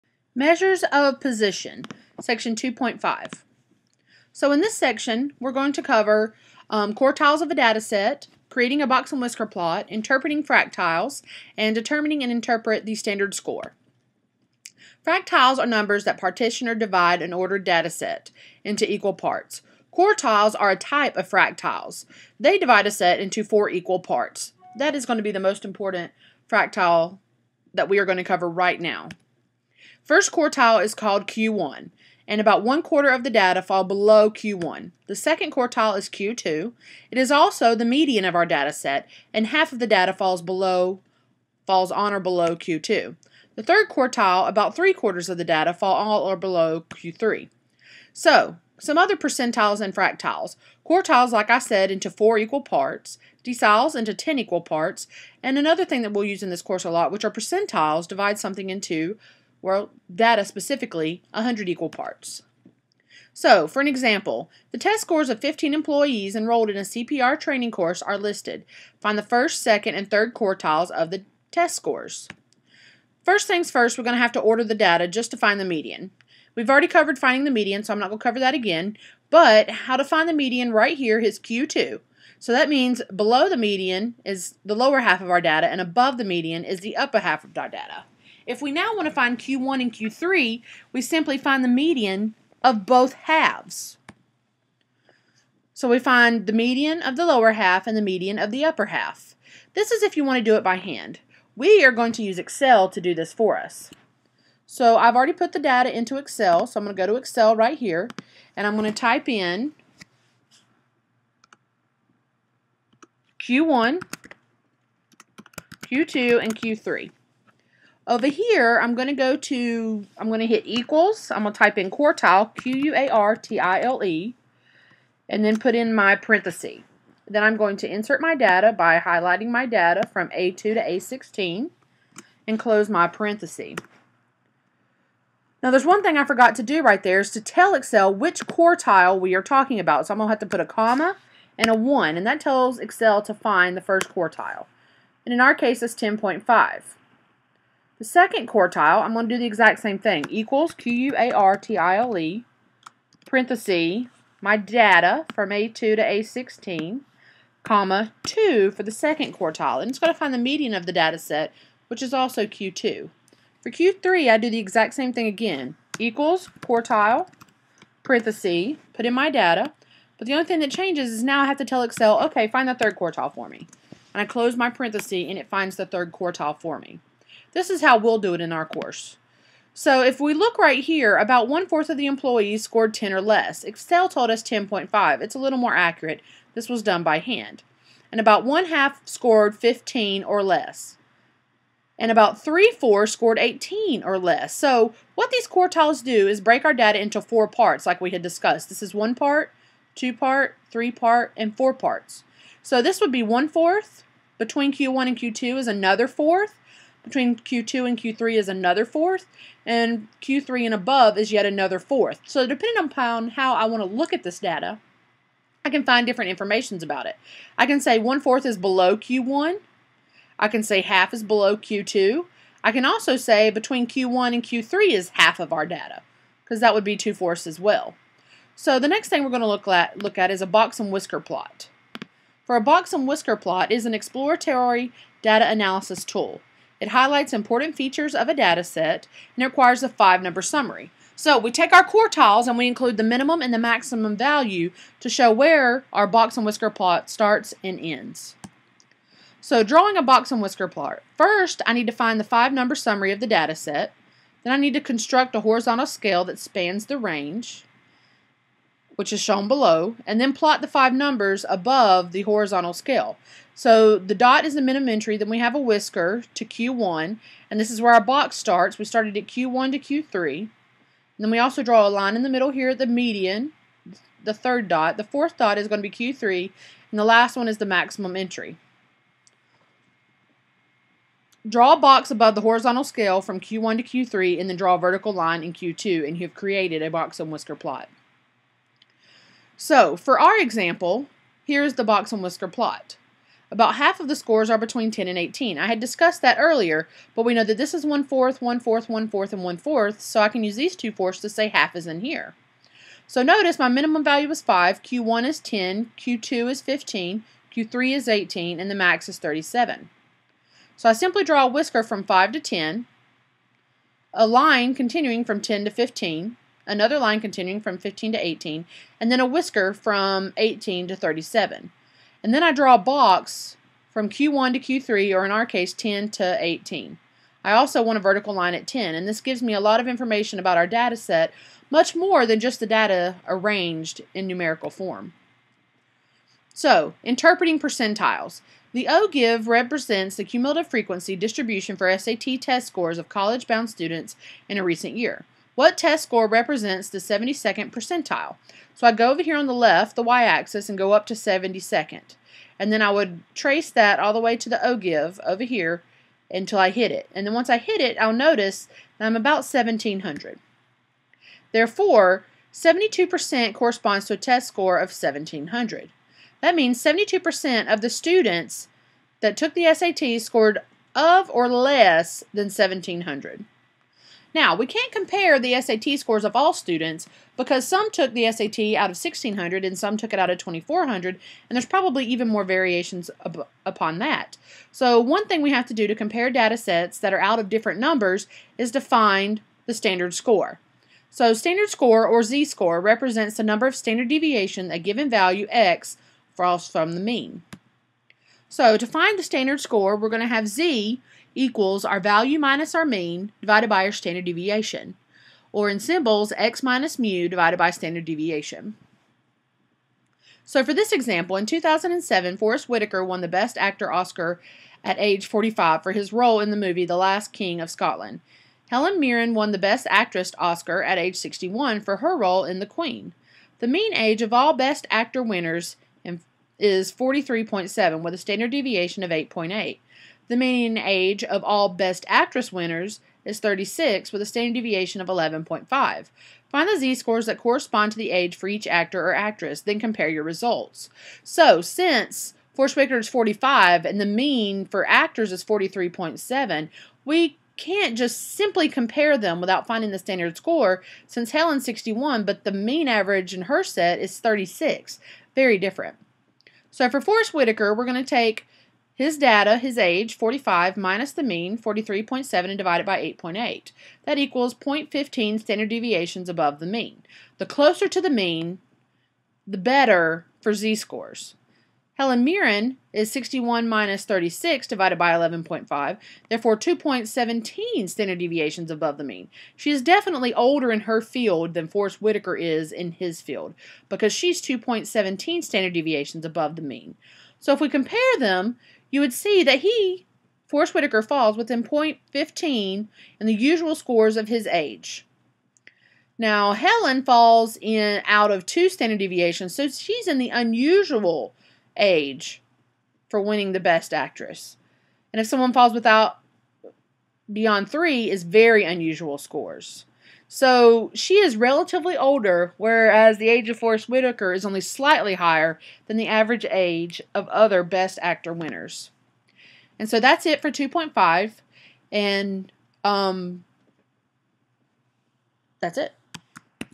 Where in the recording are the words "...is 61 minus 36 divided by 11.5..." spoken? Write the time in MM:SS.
07:52.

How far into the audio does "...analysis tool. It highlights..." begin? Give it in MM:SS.
03:55.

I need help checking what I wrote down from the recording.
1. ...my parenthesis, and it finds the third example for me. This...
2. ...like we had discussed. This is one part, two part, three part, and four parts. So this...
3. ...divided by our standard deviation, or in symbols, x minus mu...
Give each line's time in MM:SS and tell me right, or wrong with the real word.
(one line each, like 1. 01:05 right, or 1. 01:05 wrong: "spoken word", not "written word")
1. 02:54 wrong: "quartile", not "example"
2. 03:17 right
3. 06:43 right.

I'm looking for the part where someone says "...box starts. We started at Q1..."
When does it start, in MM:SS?
04:28.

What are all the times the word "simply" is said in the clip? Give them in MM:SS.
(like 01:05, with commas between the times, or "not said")
01:31, 05:10, 07:28.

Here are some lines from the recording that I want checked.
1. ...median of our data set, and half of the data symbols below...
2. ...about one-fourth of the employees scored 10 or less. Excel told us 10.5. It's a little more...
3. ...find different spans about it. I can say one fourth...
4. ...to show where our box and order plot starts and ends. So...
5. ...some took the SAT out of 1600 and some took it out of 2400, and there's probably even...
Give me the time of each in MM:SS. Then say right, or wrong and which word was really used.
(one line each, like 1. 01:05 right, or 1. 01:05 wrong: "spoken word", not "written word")
1. 00:37 wrong: "falls", not "symbols"
2. 03:01 right
3. 03:35 wrong: "informations", not "spans"
4. 04:04 wrong: "whisker", not "order"
5. 06:17 right.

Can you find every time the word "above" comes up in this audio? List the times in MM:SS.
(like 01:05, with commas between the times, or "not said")
01:25, 03:30, 04:21, 04:42, 07:46, 07:58, 08:06.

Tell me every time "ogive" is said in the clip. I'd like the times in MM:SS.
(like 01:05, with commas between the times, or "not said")
05:38, 05:54.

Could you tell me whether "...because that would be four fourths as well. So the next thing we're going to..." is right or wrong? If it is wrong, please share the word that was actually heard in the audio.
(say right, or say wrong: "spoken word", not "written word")
wrong: "two", not "four".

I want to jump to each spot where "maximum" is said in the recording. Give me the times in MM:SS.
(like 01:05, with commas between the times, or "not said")
04:03, 04:37.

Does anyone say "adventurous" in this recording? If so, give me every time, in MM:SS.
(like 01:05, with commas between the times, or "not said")
not said.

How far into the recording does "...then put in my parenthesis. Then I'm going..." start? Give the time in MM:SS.
02:05.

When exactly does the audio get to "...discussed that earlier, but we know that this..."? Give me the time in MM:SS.
04:55.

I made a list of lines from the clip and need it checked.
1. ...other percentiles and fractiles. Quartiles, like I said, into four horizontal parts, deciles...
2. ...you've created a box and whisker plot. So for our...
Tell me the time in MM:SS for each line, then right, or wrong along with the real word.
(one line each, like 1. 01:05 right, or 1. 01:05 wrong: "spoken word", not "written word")
1. 00:48 wrong: "equal", not "horizontal"
2. 04:46 right.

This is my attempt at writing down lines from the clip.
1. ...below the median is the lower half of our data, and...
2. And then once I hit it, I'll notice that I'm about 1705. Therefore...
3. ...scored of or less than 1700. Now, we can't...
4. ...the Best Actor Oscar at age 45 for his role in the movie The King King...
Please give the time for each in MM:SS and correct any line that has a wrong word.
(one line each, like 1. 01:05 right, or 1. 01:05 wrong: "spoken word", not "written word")
1. 01:23 right
2. 05:57 wrong: "1700", not "1705"
3. 06:10 right
4. 06:53 wrong: "Last", not "King".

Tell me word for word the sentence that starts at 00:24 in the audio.
That is going to be the most important fractile that we are going to cover right now.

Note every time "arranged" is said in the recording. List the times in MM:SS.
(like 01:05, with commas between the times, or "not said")
05:33.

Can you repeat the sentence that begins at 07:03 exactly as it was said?
The mean age of all Best Actor winners is 43.7 with a standard deviation of 8.8.